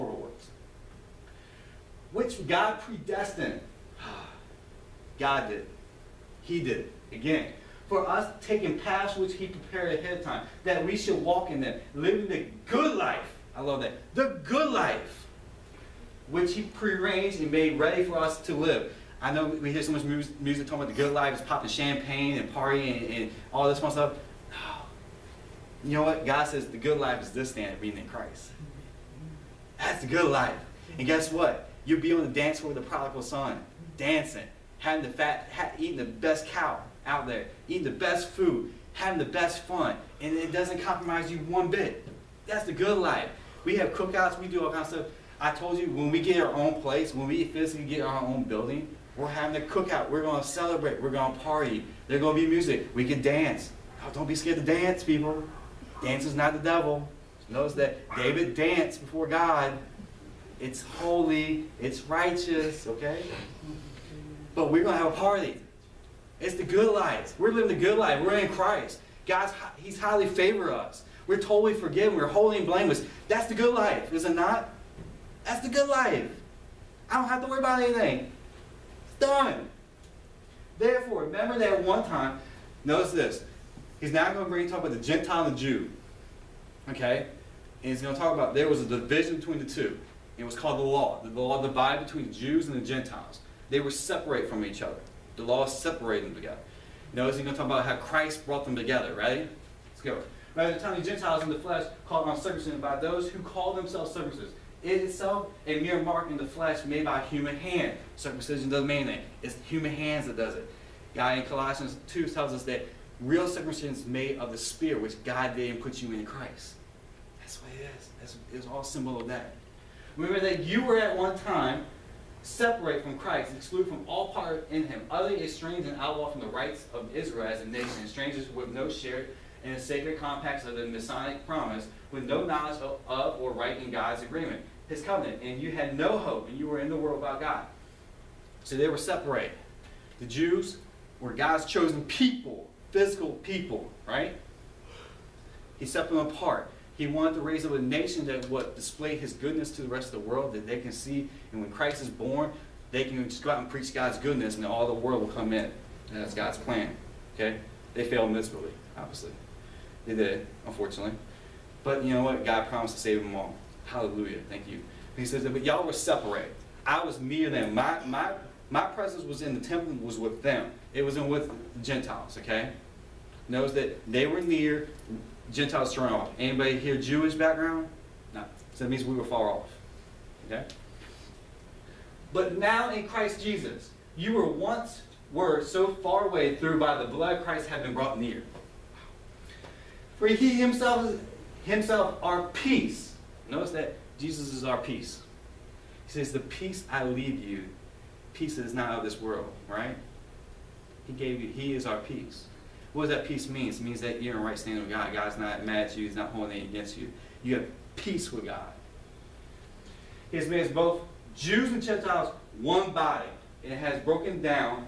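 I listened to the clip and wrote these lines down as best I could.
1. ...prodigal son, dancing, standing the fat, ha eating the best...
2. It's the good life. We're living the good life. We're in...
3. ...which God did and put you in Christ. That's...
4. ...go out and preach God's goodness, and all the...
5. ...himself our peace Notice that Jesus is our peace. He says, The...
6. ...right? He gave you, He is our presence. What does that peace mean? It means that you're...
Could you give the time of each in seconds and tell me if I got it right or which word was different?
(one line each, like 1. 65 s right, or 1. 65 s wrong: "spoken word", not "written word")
1. 32 s wrong: "having", not "standing"
2. 66 s right
3. 115 s right
4. 153 s right
5. 191 s right
6. 199 s wrong: "peace", not "presence".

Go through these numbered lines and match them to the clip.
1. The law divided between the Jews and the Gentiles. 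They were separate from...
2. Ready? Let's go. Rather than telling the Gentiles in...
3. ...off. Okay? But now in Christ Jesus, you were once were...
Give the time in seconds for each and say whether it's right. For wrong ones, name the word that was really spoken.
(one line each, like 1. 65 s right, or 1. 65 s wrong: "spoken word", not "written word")
1. 91 s right
2. 99 s right
3. 179 s right.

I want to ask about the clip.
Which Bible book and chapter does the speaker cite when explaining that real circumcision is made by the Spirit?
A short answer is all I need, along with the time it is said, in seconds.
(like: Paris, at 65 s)
Colossians 2, at 111 s.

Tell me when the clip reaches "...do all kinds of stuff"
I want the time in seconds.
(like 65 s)
44 s.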